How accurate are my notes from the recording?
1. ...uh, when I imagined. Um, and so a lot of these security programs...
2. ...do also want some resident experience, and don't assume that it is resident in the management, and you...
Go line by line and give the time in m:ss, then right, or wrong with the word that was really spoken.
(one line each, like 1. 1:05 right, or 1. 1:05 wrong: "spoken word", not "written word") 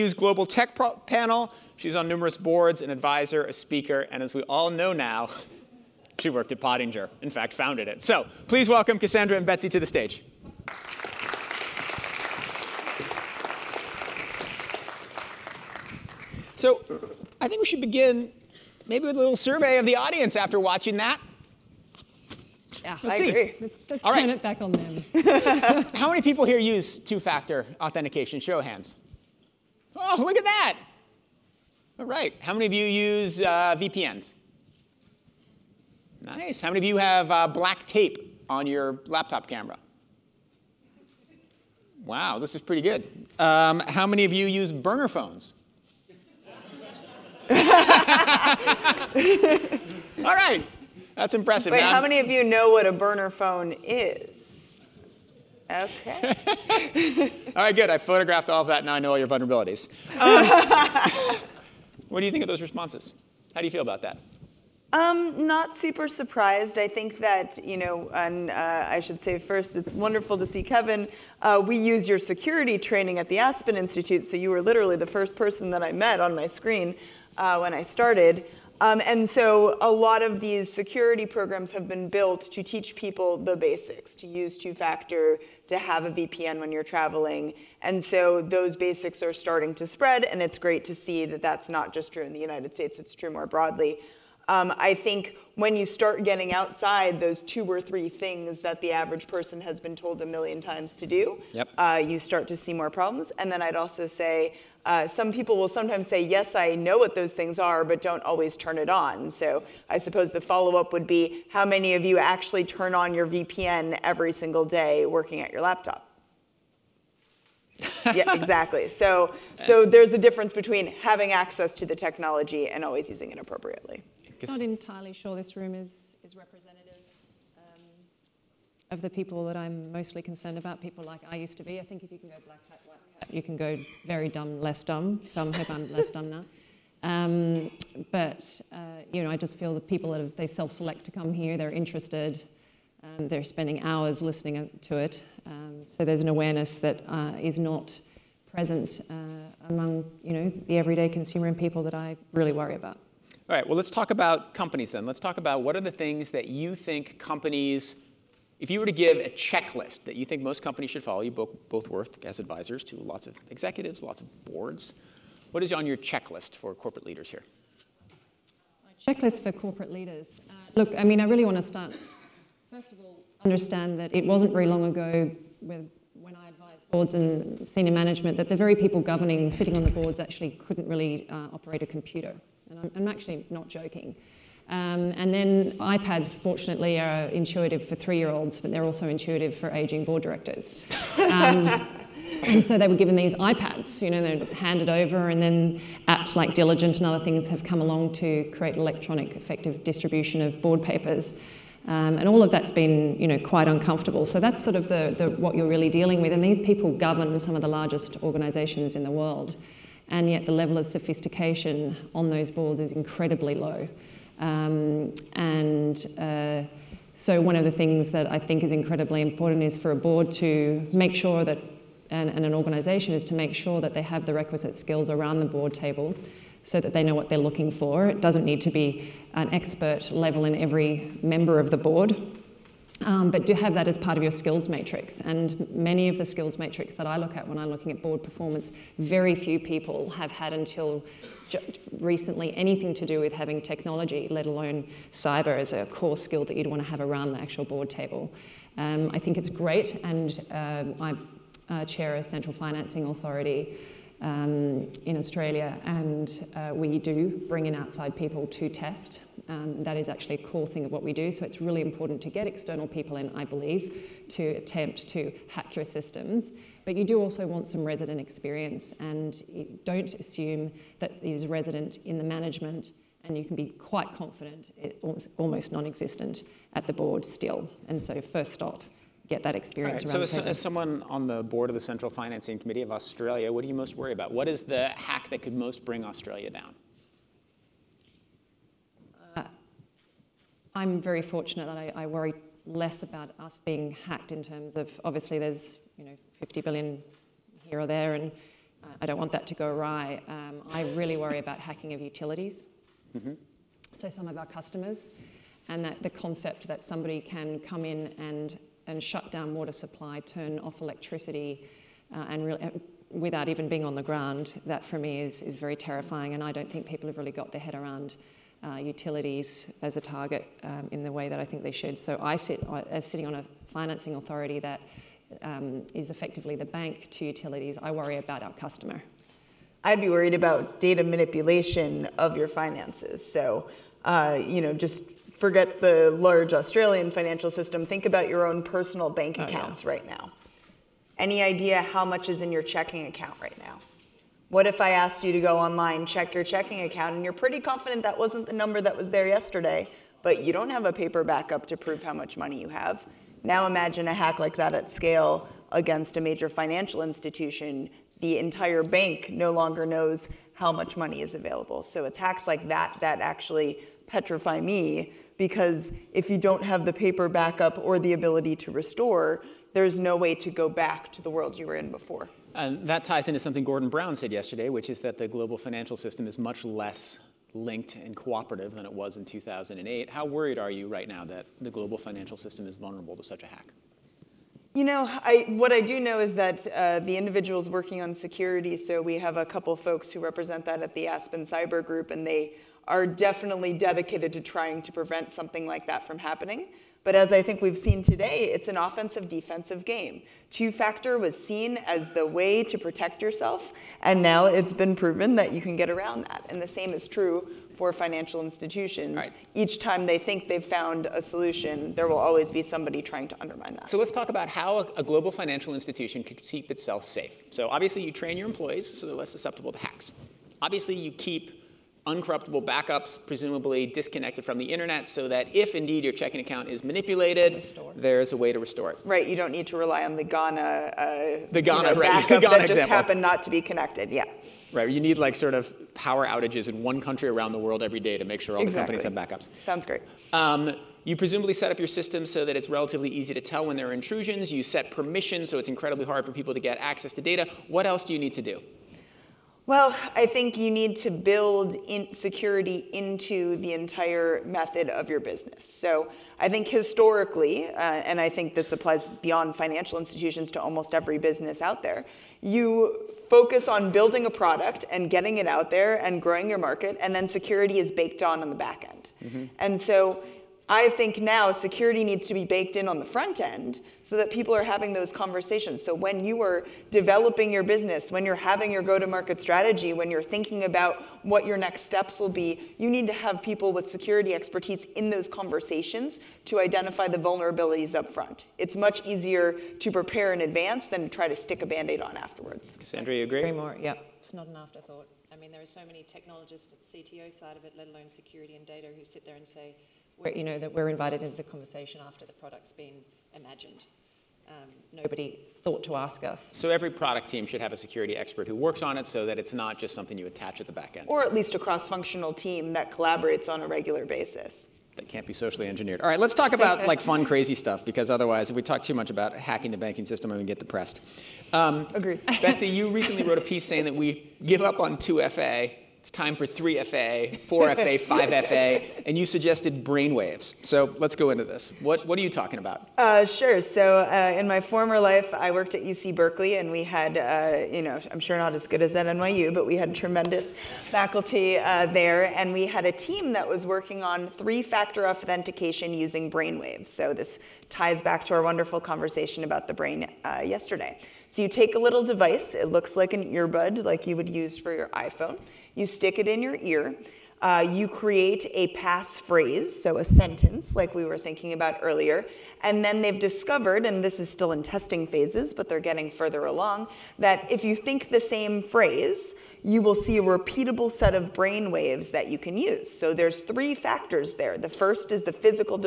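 1. 1:17 wrong: "started", not "imagined"
2. 4:27 right.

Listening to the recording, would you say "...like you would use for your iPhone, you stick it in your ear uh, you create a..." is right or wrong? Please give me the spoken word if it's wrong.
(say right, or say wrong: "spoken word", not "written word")
right.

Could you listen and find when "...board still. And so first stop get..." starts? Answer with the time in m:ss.
4:36.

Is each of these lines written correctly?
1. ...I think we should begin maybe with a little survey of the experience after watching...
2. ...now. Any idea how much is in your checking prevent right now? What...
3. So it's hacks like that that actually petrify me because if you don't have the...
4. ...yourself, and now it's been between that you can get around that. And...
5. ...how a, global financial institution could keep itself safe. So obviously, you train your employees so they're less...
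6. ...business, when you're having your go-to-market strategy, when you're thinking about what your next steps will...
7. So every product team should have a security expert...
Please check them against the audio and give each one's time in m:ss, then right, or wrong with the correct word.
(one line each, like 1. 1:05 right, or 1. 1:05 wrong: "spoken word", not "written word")
1. 0:17 wrong: "audience", not "experience"
2. 5:40 wrong: "account", not "prevent"
3. 6:01 right
4. 6:43 wrong: "proven", not "between"
5. 6:54 right
6. 7:57 right
7. 8:26 right.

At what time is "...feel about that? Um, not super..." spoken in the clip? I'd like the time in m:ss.
1:03.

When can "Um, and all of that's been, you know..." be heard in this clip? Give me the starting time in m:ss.
3:21.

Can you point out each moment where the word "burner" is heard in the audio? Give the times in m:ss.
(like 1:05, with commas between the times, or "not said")
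0:44, 0:52.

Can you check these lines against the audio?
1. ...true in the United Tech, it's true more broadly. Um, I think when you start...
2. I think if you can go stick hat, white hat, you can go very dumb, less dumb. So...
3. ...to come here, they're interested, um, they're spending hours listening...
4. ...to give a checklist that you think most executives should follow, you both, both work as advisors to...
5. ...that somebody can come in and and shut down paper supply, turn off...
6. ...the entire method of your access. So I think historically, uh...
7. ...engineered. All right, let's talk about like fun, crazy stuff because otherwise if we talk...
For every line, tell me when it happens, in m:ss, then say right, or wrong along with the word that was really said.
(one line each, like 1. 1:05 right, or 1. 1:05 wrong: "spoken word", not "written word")
1. 1:32 wrong: "States", not "Tech"
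2. 2:11 wrong: "black", not "stick"
3. 2:21 right
4. 2:38 wrong: "companies", not "executives"
5. 5:06 wrong: "water", not "paper"
6. 7:33 wrong: "business", not "access"
7. 8:35 right.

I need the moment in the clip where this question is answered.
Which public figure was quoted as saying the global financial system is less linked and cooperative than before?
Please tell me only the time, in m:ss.
6:13.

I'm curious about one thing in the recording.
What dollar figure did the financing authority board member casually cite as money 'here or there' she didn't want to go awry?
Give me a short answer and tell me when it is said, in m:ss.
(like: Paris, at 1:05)
50 billion, at 4:56.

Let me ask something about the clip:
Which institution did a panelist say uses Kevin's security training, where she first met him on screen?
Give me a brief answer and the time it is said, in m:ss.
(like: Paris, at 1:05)
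Aspen Institute, at 1:13.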